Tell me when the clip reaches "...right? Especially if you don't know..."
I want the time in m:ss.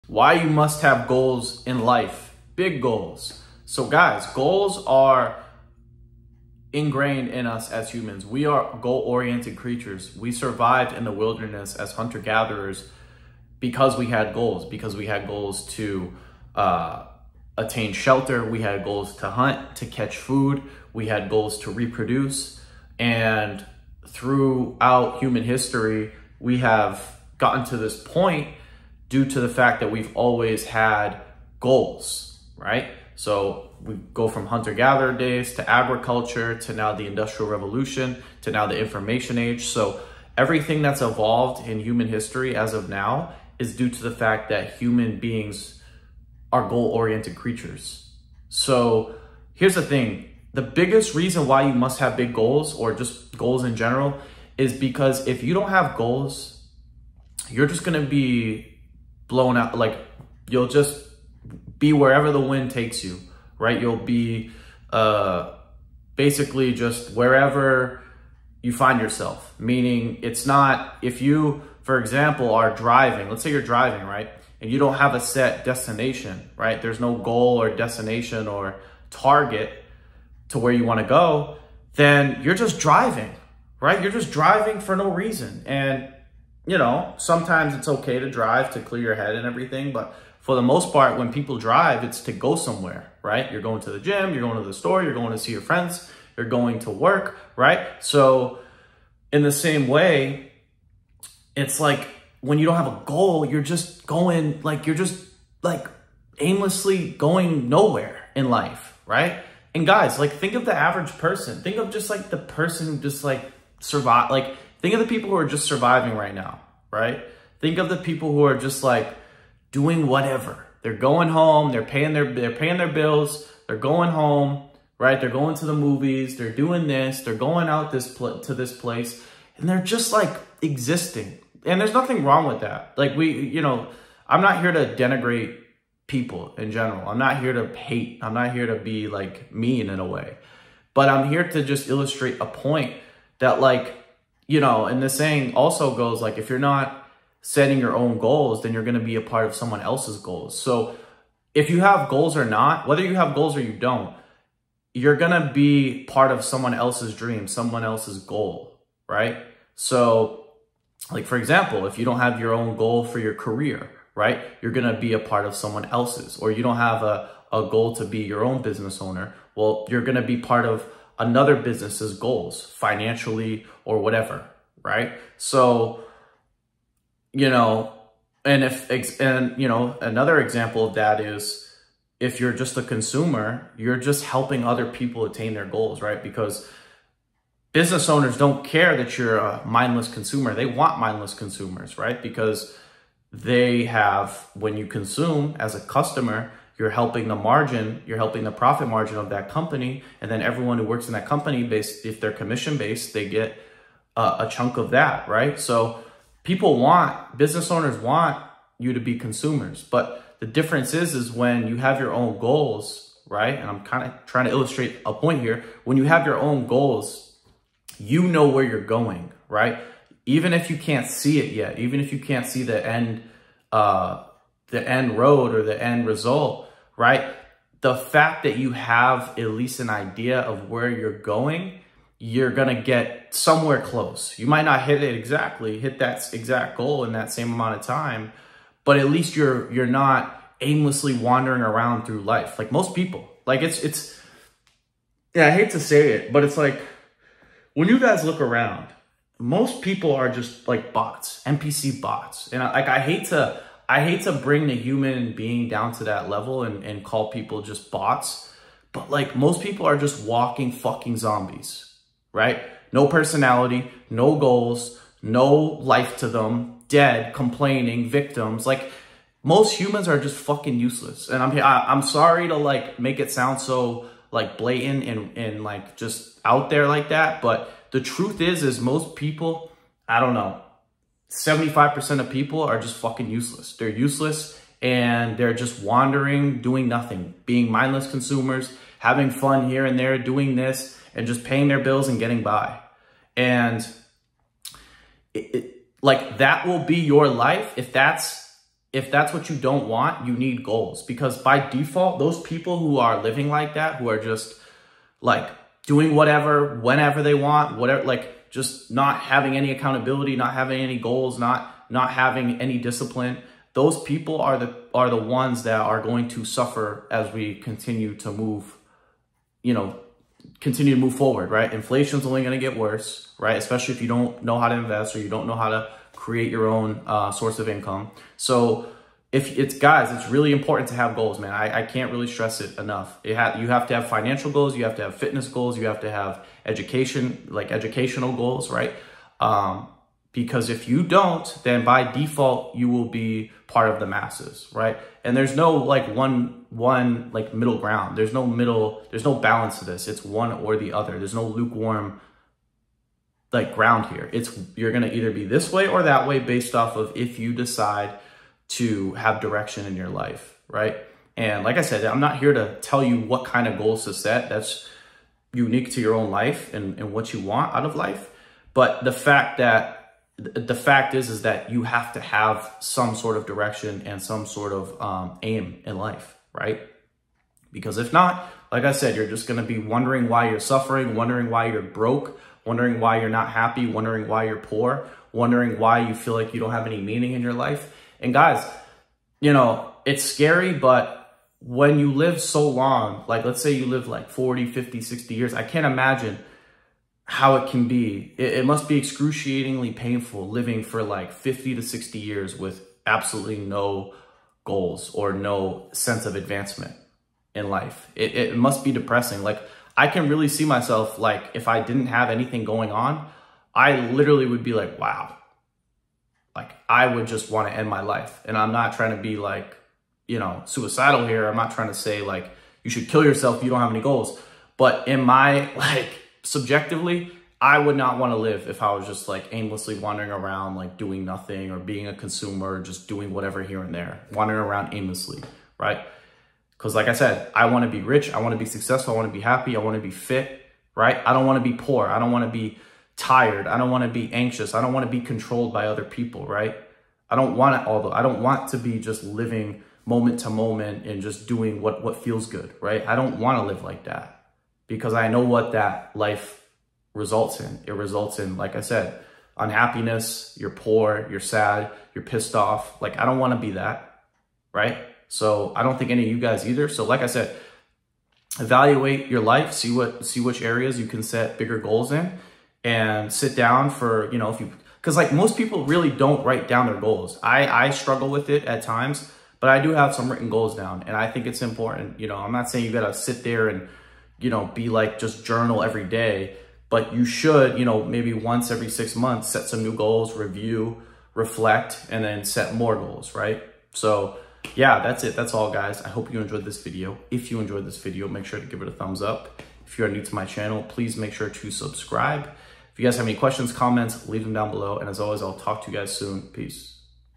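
5:23.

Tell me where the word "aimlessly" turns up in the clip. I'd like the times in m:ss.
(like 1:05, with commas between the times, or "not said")
1:46, 4:00, 7:09, 7:14.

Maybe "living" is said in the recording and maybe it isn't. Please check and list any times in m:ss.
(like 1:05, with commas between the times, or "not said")
5:03, 6:40, 7:29.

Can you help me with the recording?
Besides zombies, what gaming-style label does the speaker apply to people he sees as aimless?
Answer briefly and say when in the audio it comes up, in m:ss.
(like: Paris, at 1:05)
NPC bots, at 4:11.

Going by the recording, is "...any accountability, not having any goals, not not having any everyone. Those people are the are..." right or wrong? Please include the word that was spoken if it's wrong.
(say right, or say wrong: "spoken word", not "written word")
wrong: "discipline", not "everyone".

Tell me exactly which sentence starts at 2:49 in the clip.
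Well, you're going to be part of another business's goals financially or whatever, right?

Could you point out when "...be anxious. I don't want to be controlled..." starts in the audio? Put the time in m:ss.
7:24.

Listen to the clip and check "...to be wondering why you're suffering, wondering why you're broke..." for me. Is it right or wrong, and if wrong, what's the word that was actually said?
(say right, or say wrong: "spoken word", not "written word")
right.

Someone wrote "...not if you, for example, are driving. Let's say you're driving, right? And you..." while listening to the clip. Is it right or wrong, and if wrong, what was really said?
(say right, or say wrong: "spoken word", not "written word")
right.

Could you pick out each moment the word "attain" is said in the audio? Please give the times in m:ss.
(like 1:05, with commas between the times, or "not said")
0:17, 3:05.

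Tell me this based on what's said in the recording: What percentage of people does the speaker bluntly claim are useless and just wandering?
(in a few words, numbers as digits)
75%.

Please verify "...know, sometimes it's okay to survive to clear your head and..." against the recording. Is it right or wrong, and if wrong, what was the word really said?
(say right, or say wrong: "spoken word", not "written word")
wrong: "drive", not "survive".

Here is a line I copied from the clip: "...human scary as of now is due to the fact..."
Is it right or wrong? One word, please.
wrong.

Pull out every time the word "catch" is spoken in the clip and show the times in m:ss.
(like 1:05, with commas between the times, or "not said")
0:19.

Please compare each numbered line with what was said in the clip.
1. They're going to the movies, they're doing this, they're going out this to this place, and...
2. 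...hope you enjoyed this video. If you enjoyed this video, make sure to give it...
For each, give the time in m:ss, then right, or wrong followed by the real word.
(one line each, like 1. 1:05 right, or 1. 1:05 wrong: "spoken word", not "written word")
1. 2:05 right
2. 8:16 right.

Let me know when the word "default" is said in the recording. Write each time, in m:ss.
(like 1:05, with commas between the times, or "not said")
5:01, 5:42.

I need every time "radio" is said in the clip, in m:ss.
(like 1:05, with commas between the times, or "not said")
not said.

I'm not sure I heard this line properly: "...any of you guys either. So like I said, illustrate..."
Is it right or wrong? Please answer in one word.
wrong.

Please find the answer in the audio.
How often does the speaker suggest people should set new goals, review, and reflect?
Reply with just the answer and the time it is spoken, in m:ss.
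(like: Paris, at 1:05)
once every six months, at 8:08.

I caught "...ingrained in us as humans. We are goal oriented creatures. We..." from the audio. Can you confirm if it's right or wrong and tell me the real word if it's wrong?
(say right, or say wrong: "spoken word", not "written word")
right.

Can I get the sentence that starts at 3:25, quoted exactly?
So people want, business owners want you to be consumers.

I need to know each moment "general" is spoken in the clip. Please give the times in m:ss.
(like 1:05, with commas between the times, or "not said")
0:53, 2:16.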